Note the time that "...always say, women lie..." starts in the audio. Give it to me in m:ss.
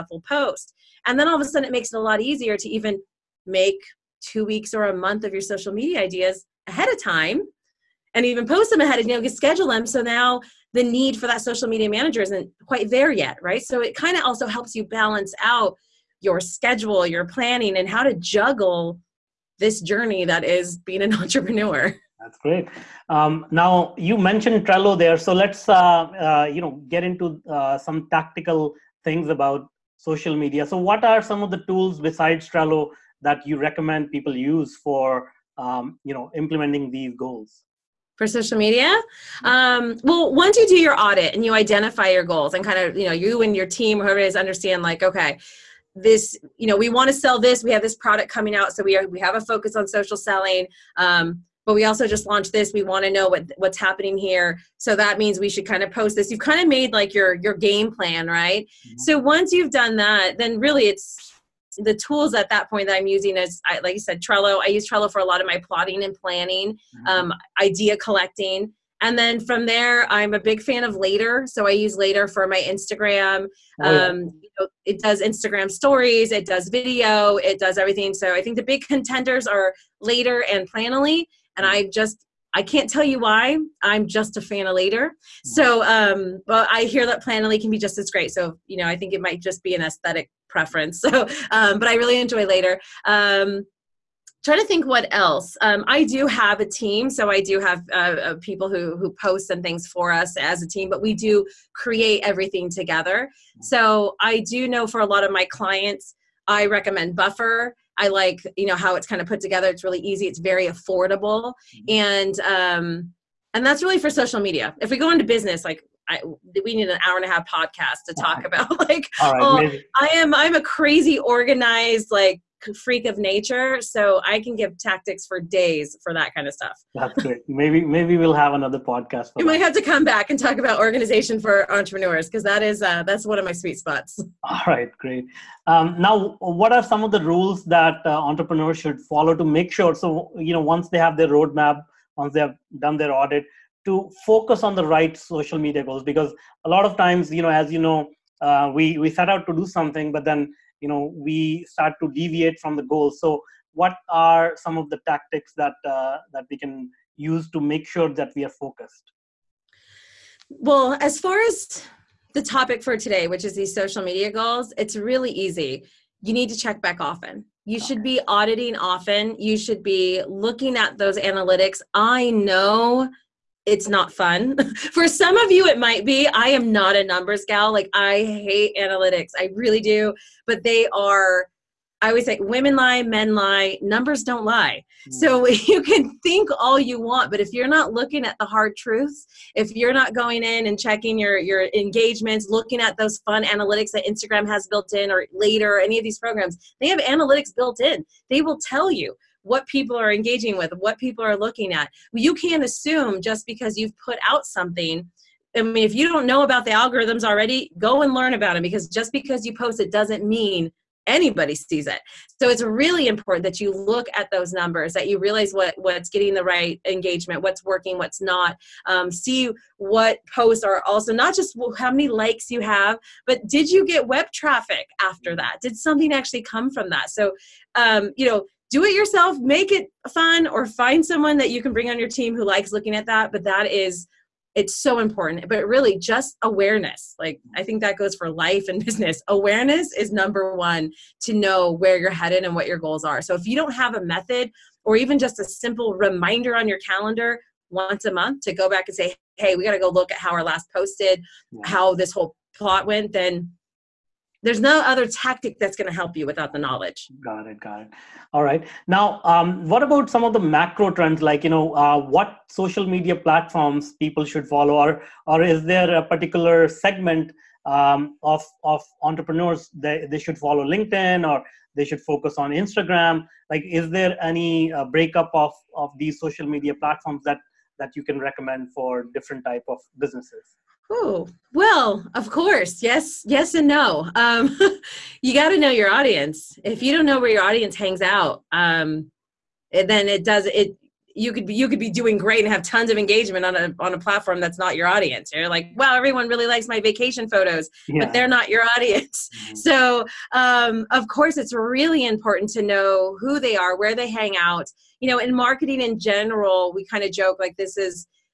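3:02.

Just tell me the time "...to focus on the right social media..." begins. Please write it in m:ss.
2:23.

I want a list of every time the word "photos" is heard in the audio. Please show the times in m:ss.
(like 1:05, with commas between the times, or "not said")
4:57.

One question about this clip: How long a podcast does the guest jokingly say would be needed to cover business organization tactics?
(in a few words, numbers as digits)
an hour and a half.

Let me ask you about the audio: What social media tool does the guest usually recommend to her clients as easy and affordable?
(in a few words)
Buffer.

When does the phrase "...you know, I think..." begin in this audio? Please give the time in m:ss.
1:28.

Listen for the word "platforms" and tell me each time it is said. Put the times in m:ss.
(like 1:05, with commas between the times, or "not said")
4:23, 4:36, 4:53.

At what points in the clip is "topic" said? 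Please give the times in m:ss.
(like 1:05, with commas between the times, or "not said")
2:42.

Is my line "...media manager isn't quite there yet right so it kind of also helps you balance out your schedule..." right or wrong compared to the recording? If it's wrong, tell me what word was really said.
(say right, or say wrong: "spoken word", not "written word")
right.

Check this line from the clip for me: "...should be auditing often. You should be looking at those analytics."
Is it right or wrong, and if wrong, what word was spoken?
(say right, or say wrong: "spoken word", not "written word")
right.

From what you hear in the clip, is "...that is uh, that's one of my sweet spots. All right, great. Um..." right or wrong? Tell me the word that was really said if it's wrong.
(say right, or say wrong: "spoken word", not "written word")
right.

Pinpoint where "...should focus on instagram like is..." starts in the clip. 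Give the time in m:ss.
4:31.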